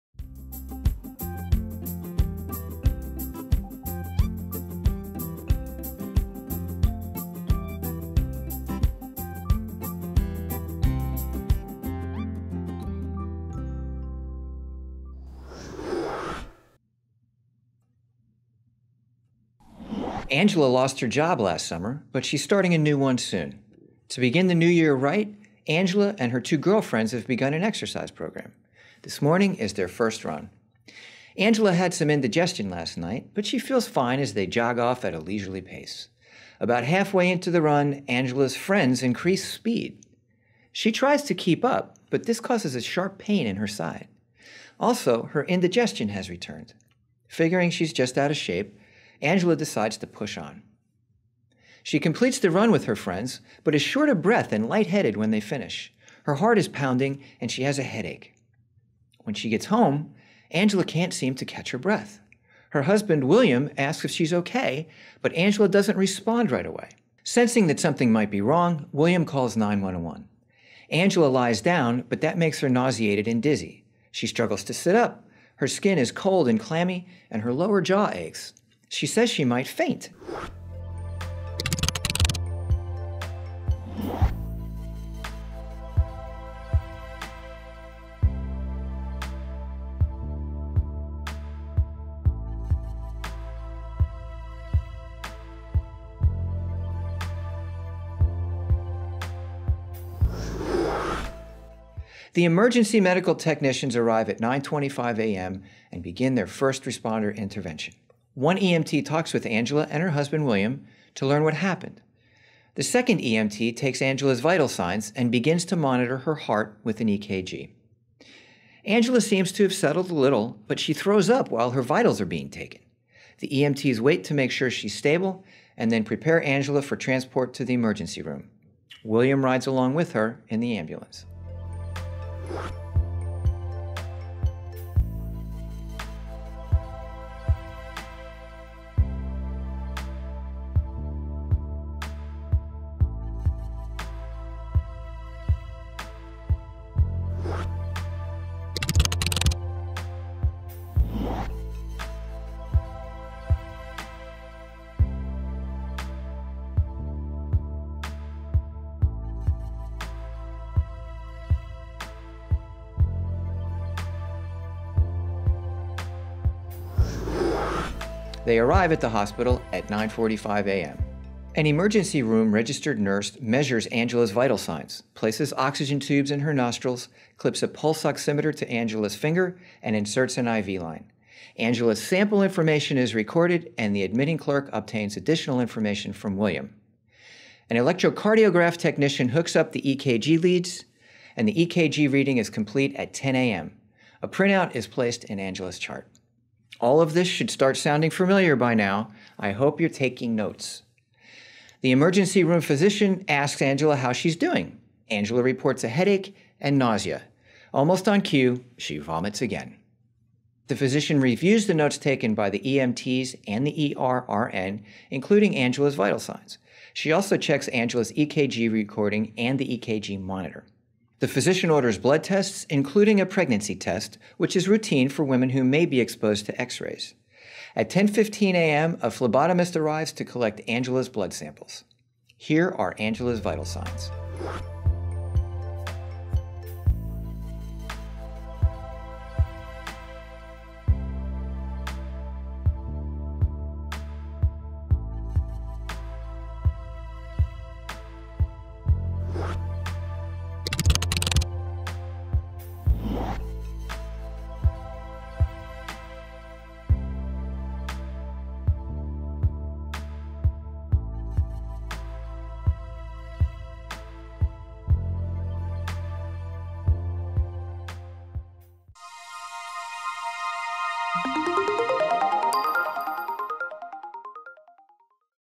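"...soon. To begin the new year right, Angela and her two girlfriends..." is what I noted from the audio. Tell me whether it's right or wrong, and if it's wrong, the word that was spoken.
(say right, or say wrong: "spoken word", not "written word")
right.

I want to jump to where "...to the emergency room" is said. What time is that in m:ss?
2:07.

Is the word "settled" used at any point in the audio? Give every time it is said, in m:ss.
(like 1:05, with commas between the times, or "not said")
1:59.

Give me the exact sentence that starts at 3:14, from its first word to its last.
A printout is placed in Angela's chart.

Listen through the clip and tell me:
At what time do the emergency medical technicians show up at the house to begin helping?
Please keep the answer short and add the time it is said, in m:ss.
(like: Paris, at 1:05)
9:25 a.m., at 1:44.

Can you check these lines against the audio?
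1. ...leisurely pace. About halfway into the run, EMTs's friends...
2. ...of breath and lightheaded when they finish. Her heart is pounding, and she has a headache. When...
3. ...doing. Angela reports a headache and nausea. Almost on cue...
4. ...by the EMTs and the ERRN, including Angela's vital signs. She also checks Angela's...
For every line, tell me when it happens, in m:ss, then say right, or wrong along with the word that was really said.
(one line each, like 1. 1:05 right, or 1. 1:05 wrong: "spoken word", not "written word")
1. 0:35 wrong: "Angela", not "EMTs"
2. 0:54 right
3. 3:24 right
4. 3:32 right.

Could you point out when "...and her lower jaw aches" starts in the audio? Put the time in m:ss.
1:17.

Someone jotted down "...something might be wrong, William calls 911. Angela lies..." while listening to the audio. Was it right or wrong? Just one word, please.
right.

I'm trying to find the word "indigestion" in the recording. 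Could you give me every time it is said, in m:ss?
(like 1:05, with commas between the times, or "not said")
0:32, 0:45.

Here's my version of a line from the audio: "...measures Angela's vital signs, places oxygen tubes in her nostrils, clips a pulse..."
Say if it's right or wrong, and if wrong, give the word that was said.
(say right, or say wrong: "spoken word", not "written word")
right.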